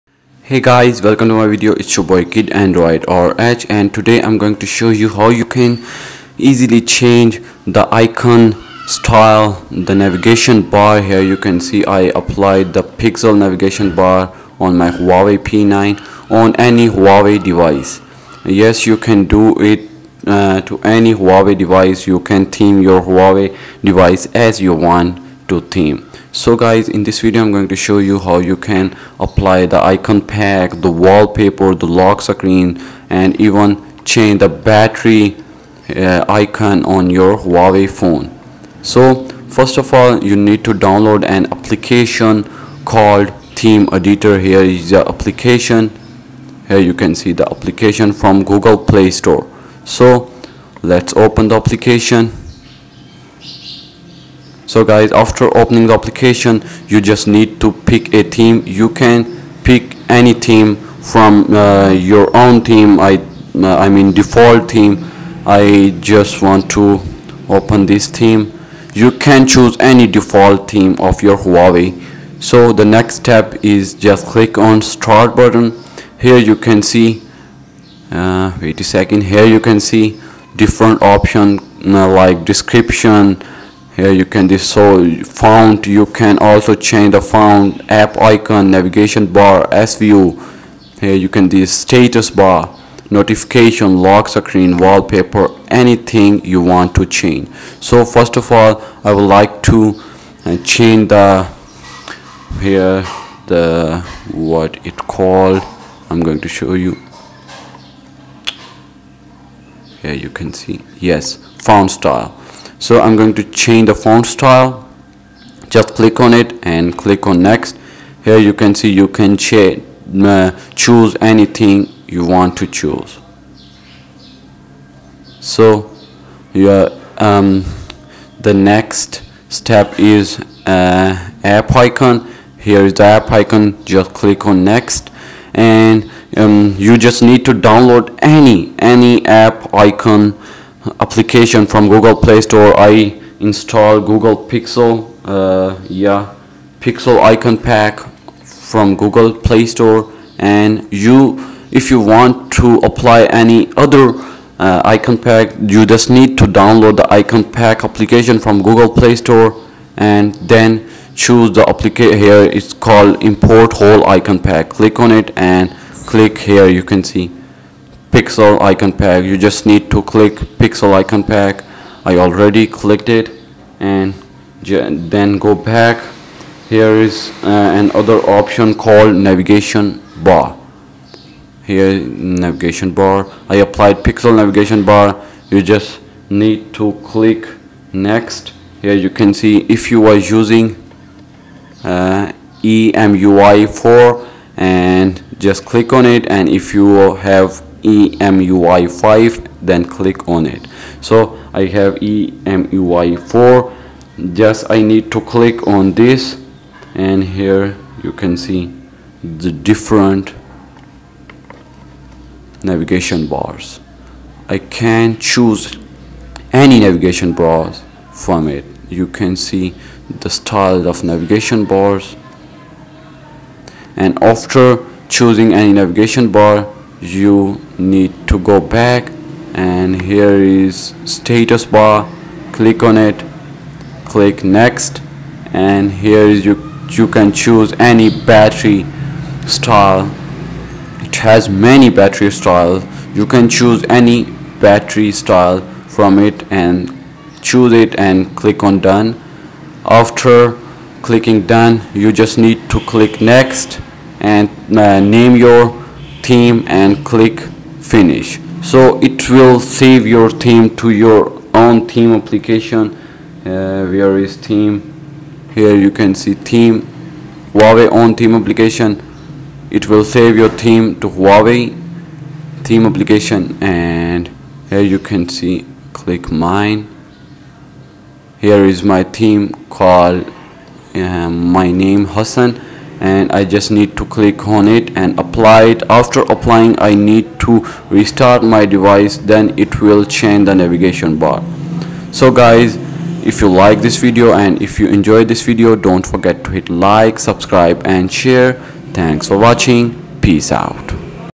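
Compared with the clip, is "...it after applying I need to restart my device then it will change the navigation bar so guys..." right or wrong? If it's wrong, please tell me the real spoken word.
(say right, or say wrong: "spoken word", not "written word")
right.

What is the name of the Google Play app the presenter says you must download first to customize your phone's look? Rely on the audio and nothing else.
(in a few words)
Theme Editor.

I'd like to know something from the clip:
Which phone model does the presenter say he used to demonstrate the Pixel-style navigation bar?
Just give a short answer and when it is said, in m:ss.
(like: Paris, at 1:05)
Huawei P9, at 0:14.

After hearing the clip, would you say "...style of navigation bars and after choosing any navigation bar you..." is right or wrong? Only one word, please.
right.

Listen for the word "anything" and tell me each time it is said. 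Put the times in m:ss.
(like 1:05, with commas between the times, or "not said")
1:35, 2:01.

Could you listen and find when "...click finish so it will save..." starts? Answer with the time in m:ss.
4:17.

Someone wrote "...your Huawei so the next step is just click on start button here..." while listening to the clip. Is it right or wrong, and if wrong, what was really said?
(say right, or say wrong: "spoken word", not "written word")
right.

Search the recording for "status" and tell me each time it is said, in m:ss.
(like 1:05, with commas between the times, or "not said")
1:31, 3:51.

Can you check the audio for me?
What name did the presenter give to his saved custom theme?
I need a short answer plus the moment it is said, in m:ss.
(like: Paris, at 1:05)
Hassan, at 4:42.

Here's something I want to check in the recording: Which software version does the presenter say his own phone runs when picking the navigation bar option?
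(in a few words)
EMUI 4.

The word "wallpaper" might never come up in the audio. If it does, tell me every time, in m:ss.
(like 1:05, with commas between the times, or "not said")
0:31, 1:34.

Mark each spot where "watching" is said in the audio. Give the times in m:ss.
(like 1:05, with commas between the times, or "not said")
4:59.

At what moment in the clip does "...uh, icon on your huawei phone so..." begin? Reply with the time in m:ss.
0:35.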